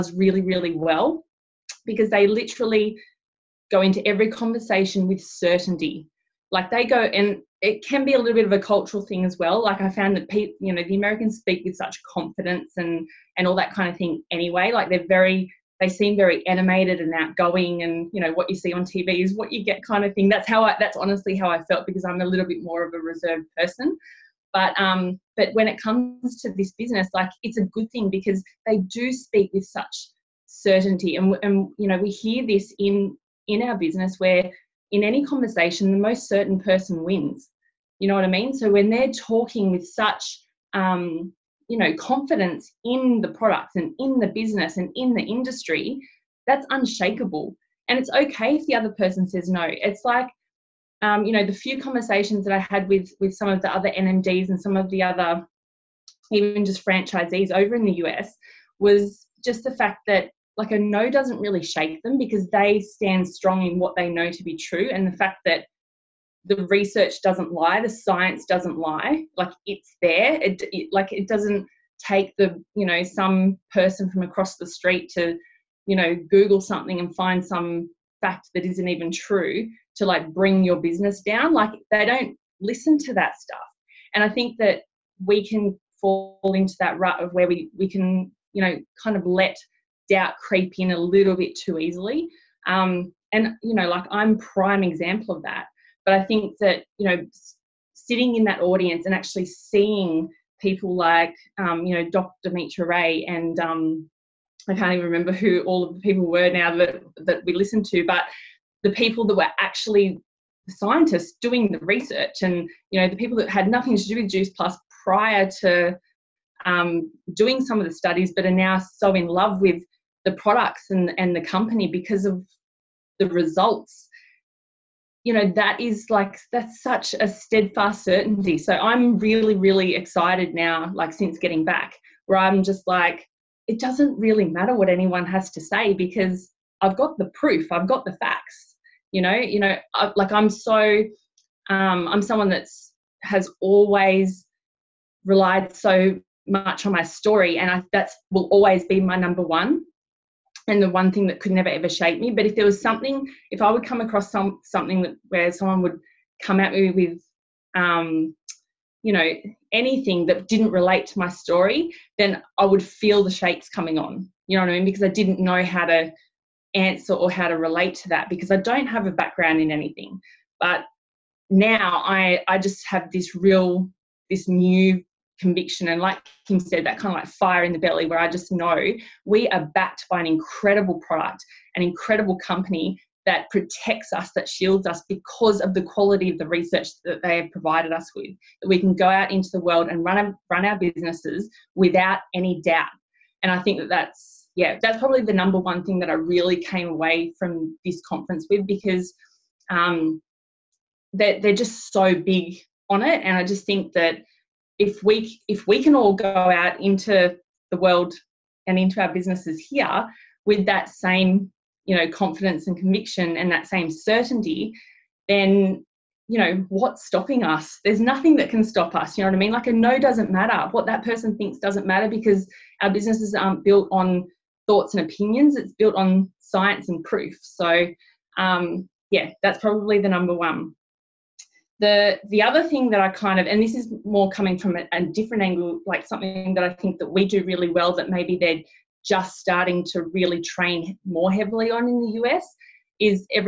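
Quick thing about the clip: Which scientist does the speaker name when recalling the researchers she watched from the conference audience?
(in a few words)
Dr. Mitra Ray.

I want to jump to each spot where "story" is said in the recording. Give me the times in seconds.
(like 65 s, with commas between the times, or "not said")
147 s, 161 s.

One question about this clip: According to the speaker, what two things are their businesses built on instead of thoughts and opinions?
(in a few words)
Science and proof.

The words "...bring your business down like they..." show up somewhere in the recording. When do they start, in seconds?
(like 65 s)
80 s.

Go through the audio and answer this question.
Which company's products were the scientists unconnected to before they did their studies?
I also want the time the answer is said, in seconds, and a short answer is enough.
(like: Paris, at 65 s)
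Juice Plus, at 114 s.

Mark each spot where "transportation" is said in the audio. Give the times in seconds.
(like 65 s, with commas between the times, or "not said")
not said.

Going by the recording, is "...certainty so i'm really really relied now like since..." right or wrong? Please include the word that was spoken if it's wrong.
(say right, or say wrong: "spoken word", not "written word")
wrong: "excited", not "relied".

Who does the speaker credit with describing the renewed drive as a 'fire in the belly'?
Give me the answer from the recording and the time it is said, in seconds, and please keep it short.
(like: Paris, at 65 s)
Kim, at 176 s.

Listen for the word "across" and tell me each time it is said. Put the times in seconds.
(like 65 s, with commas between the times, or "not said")
74 s, 153 s.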